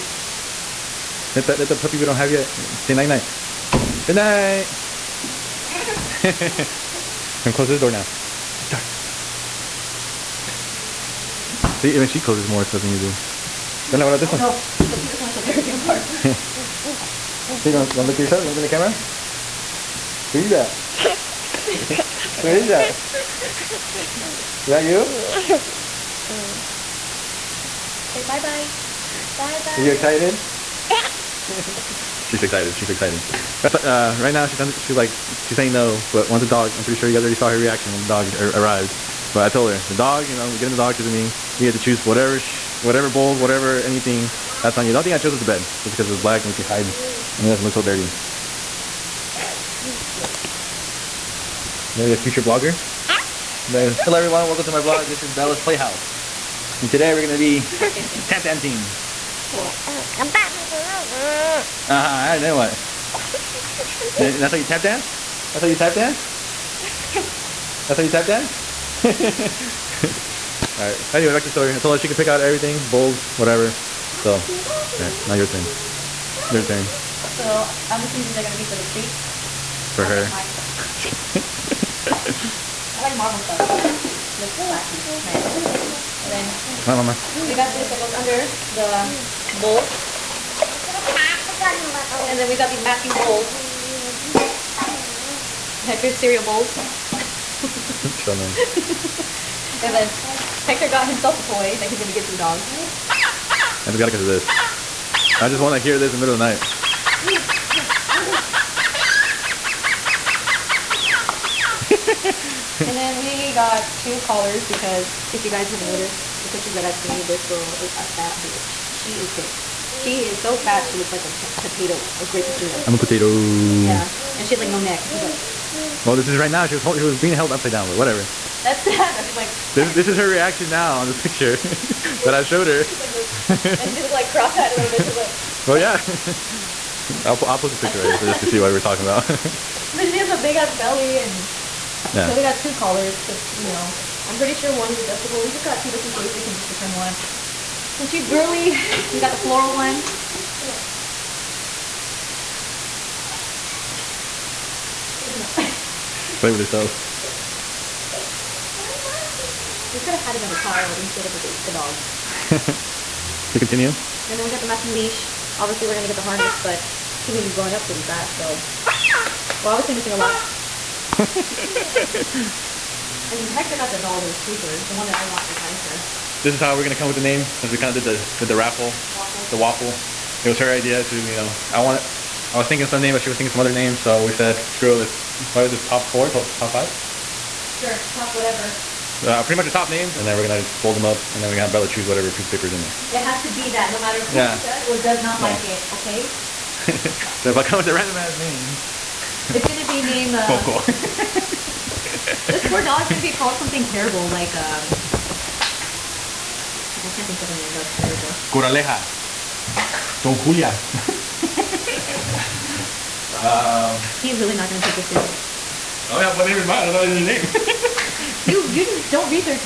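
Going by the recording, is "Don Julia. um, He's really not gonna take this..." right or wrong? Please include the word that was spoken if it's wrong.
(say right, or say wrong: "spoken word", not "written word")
right.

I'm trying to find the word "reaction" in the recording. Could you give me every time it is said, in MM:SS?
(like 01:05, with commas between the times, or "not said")
00:37, 02:10.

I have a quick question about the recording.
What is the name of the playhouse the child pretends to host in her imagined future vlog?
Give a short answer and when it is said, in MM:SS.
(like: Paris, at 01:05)
Bella's Playhouse, at 00:55.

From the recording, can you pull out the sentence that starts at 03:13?
It has to be that, no matter who yeah.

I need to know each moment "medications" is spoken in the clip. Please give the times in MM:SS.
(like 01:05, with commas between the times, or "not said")
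not said.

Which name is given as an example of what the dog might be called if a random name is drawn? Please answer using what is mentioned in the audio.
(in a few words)
Coco.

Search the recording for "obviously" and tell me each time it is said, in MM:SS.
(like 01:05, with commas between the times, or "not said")
02:45, 02:49.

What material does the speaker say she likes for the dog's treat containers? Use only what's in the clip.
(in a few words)
Marble.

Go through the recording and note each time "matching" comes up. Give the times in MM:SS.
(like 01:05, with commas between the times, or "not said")
01:32, 02:44.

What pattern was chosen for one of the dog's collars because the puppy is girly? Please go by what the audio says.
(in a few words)
Floral.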